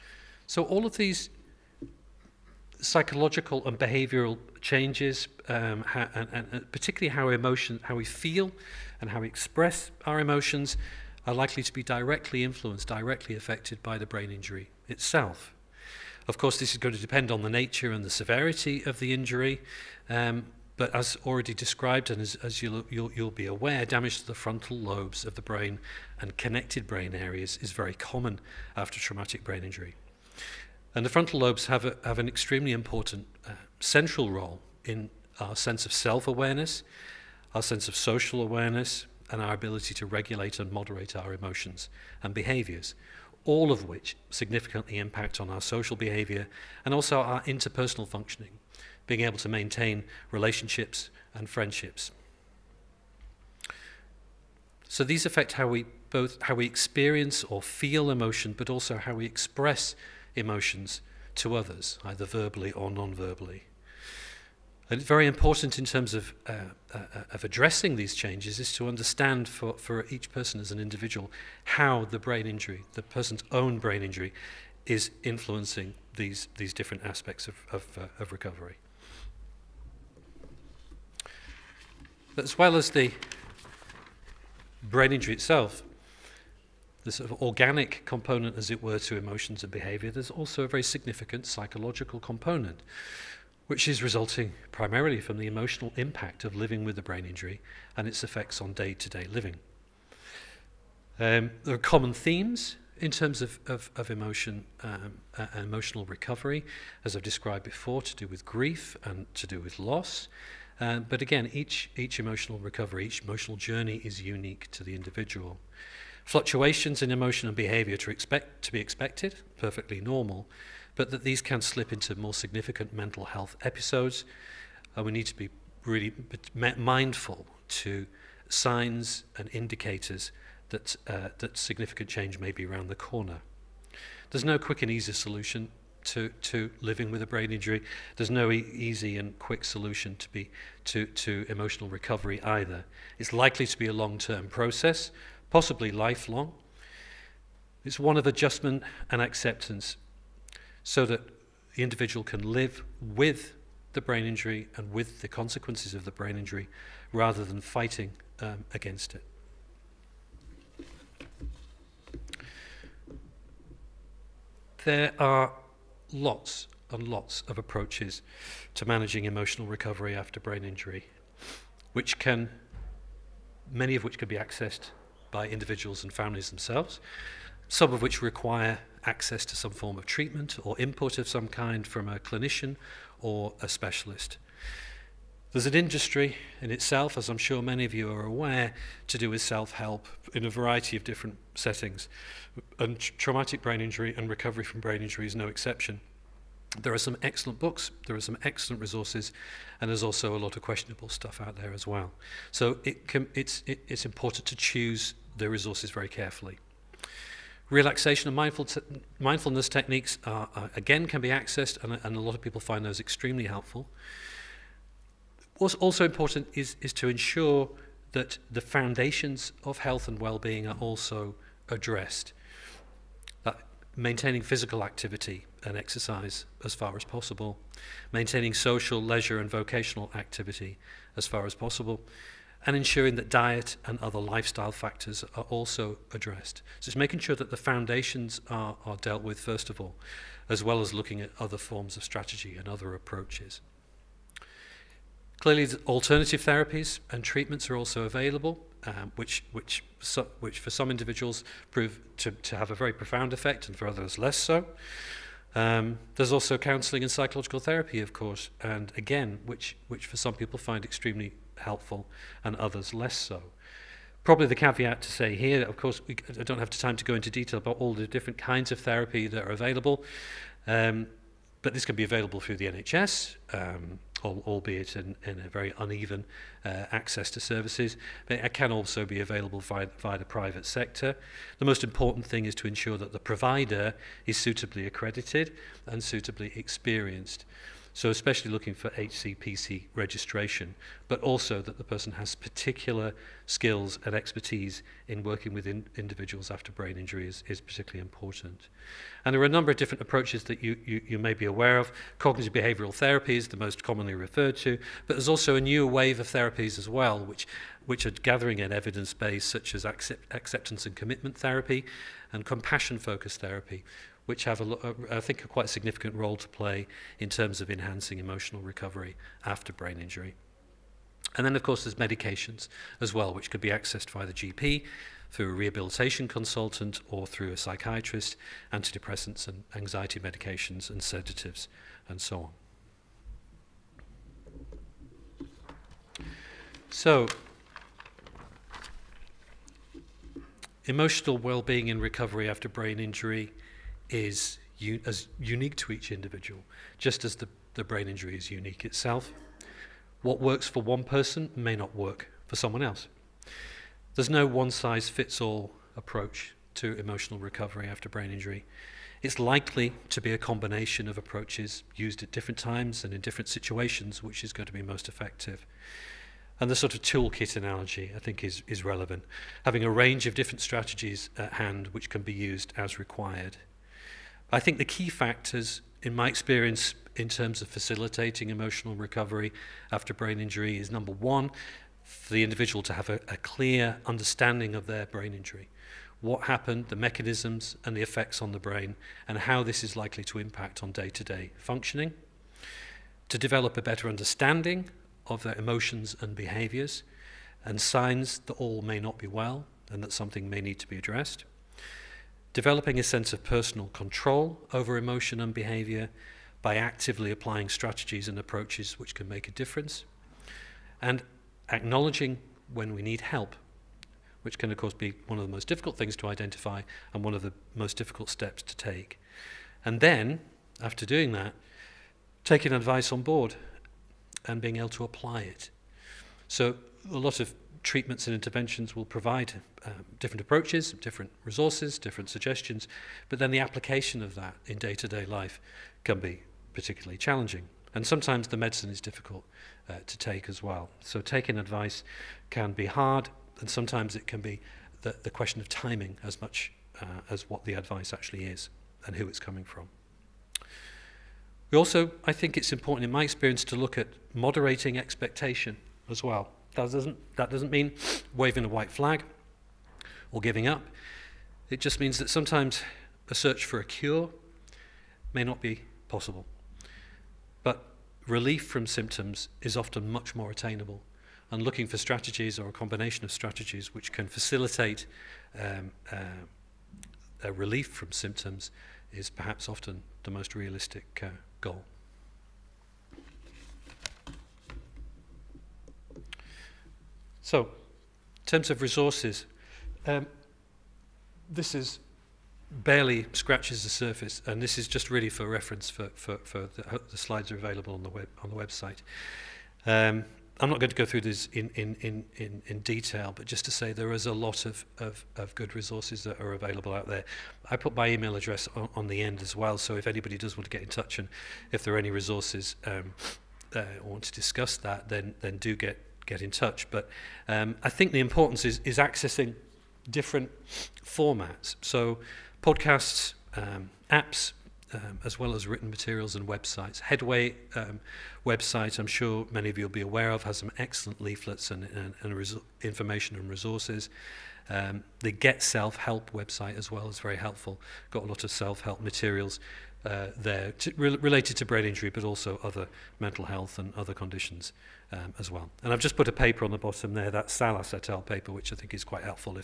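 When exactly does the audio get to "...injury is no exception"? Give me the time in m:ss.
3:15.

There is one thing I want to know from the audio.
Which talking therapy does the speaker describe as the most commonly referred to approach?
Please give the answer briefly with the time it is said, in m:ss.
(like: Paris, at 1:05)
Cognitive behavioral therapy, at 5:02.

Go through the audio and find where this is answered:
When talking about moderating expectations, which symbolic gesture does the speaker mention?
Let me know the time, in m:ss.
7:38.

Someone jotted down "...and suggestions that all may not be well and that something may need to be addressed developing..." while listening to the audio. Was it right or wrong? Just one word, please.
wrong.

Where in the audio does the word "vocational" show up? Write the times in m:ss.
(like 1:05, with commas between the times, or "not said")
3:49.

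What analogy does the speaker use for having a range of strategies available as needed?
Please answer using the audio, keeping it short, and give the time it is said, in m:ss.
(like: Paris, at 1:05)
toolkit, at 6:07.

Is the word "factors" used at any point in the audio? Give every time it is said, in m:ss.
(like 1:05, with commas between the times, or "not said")
3:54, 6:15.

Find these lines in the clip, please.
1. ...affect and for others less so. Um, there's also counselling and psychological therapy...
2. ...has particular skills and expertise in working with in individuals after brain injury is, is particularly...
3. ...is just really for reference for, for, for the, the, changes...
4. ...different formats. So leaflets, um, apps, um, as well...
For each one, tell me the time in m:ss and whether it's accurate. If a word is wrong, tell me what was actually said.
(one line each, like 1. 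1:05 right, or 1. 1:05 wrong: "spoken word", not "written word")
1. 4:13 wrong: "effect", not "affect"
2. 4:52 right
3. 8:14 wrong: "slides", not "changes"
4. 8:40 wrong: "podcasts", not "leaflets".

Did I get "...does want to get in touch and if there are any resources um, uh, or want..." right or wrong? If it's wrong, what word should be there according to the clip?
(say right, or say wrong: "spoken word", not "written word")
right.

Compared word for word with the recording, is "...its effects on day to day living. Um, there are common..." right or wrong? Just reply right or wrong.
right.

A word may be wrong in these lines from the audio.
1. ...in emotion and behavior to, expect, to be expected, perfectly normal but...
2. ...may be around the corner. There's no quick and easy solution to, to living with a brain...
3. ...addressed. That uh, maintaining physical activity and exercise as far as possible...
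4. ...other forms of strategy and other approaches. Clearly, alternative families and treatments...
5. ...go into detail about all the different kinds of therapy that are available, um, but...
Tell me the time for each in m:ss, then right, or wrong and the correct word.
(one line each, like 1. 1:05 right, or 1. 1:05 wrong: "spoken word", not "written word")
1. 1:57 right
2. 2:12 right
3. 3:41 right
4. 4:01 wrong: "therapies", not "families"
5. 4:27 right.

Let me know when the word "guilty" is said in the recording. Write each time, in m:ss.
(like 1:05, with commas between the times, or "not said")
not said.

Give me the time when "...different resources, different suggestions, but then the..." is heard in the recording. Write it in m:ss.
7:10.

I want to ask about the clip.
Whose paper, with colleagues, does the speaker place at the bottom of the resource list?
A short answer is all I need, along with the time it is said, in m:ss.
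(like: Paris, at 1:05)
Salas, at 9:07.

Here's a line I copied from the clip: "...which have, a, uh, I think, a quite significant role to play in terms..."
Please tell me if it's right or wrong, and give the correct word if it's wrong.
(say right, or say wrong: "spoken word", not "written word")
right.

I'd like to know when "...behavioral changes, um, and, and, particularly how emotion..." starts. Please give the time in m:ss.
0:03.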